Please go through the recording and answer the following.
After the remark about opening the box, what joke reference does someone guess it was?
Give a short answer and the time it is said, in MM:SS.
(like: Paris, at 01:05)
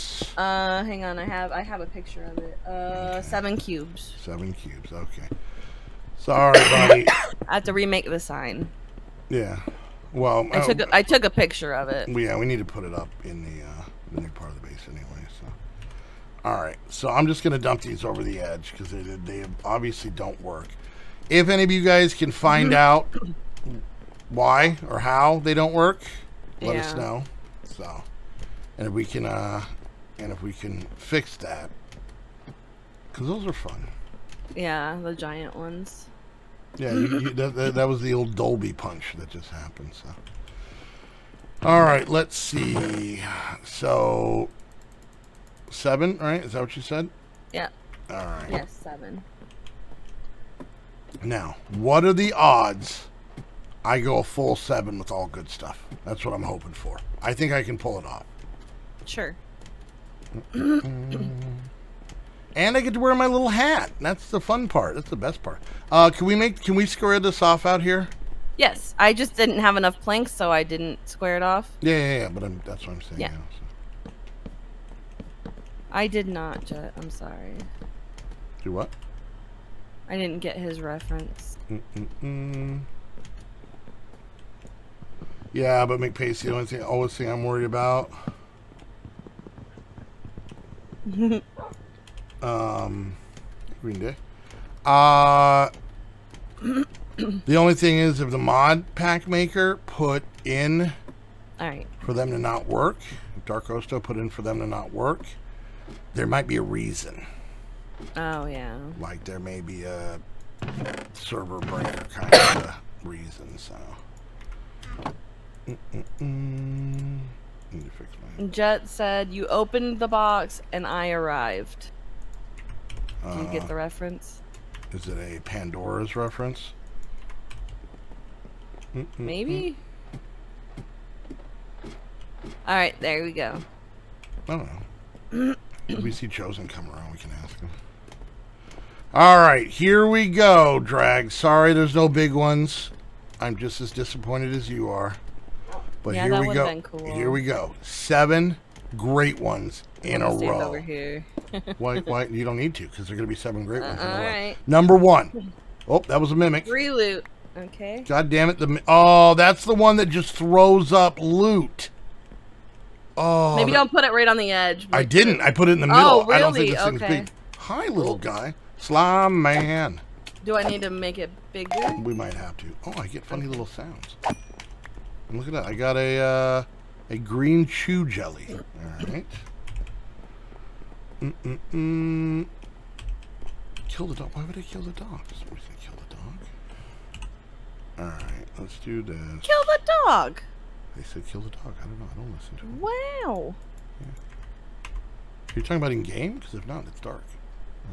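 Pandora's, at 02:05.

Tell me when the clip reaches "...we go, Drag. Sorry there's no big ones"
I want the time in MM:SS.
02:20.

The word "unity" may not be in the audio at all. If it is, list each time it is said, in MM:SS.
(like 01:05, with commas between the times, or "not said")
not said.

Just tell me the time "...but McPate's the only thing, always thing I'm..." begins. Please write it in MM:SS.
01:25.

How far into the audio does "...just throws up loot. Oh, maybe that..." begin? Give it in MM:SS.
02:40.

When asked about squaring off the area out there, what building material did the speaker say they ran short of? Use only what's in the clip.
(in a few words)
planks.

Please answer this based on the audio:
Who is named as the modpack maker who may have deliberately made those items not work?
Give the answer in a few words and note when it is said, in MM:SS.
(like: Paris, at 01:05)
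Darkosto, at 01:43.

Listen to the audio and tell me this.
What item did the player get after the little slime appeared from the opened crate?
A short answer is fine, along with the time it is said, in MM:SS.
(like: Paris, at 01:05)
a green chew jelly, at 02:57.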